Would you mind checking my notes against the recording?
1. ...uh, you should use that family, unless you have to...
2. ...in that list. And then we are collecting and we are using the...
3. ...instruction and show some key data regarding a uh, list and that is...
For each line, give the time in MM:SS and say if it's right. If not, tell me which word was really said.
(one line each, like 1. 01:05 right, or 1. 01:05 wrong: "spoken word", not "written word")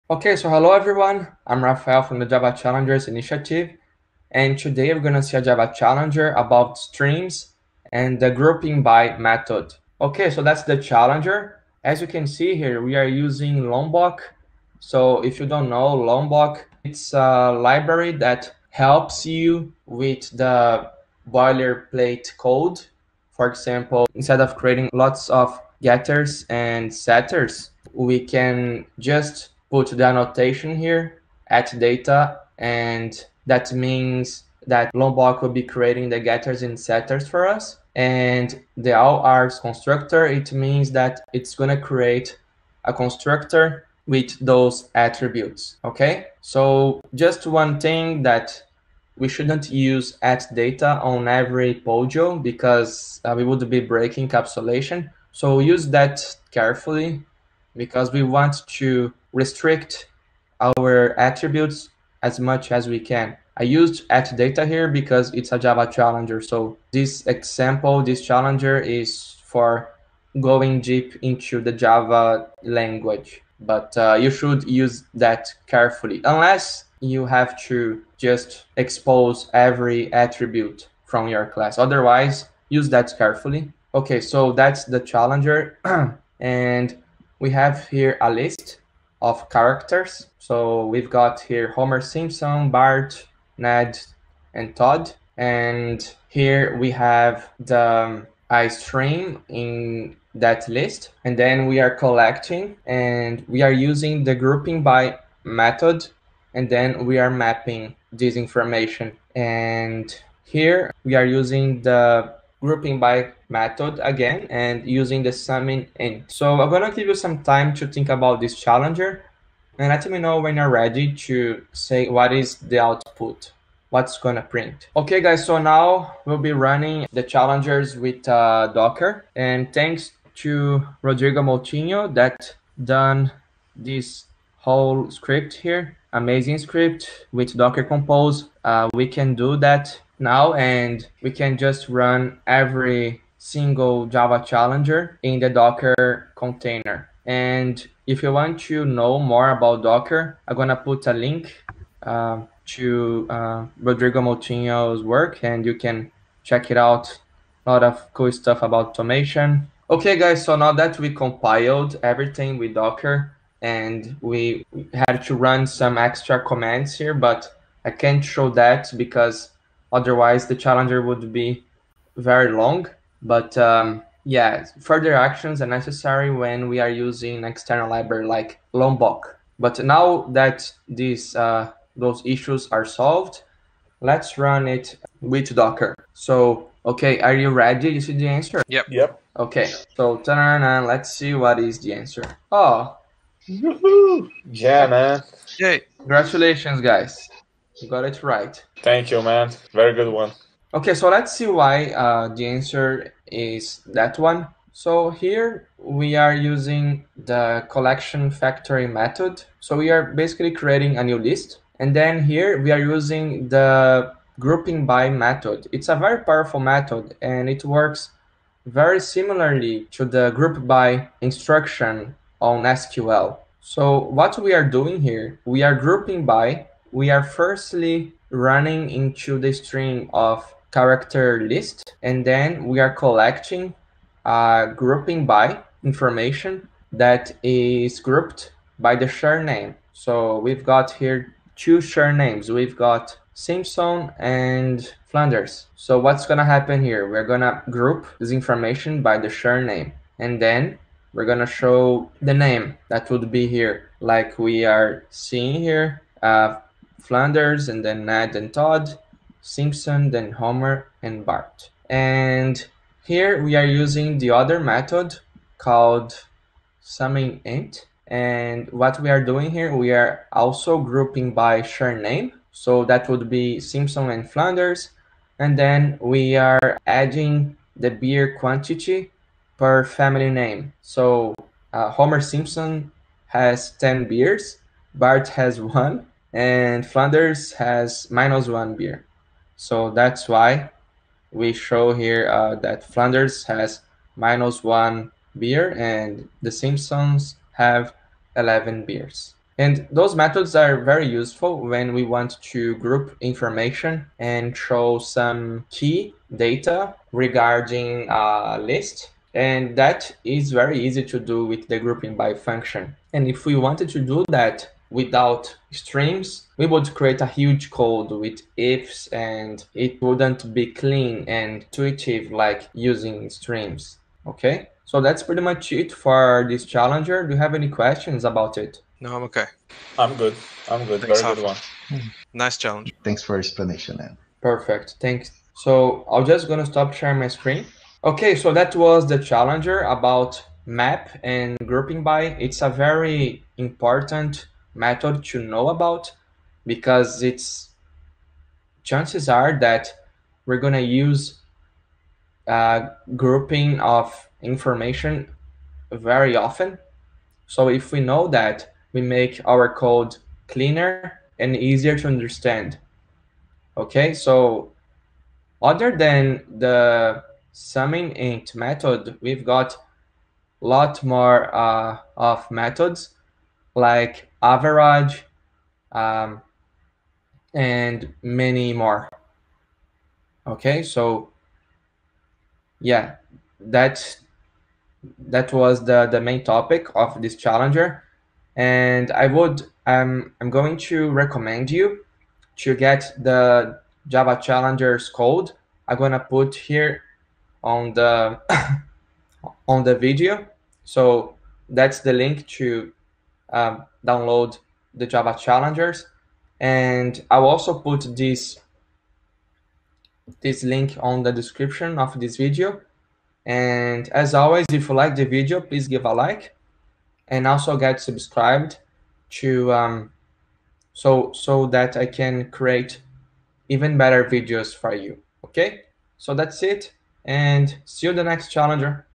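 1. 01:13 wrong: "carefully", not "family"
2. 01:39 right
3. 05:03 wrong: "information", not "instruction".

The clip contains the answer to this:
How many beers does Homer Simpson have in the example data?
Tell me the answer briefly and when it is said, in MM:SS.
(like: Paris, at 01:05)
10, at 04:43.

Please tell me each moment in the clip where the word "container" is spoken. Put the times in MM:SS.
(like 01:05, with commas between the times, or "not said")
02:26.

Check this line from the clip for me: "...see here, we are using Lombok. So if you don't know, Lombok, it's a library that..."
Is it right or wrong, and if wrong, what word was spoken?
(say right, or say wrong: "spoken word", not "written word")
right.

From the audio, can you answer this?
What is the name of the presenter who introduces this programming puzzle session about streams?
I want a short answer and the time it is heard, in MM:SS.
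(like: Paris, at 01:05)
Rafael, at 00:01.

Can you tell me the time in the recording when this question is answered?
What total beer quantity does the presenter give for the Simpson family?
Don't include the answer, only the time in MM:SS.
04:58.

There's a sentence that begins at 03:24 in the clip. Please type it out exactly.
So here we are using the collection factory method.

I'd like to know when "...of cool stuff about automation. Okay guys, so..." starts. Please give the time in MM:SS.
02:37.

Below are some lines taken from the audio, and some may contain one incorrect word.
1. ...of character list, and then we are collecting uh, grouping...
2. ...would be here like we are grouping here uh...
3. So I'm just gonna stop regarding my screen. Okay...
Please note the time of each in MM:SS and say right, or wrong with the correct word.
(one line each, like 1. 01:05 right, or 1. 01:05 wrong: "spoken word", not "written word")
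1. 03:50 right
2. 04:13 wrong: "seeing", not "grouping"
3. 05:35 wrong: "sharing", not "regarding".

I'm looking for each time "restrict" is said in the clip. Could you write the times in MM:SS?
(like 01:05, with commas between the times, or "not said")
00:59.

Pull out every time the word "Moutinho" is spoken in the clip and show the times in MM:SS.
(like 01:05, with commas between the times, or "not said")
02:11, 02:34.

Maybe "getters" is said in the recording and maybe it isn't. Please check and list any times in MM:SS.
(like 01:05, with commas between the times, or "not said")
00:25, 00:36.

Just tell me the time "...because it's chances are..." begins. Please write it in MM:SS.
05:46.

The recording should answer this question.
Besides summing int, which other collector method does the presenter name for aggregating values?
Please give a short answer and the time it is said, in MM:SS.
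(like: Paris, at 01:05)
average, at 06:14.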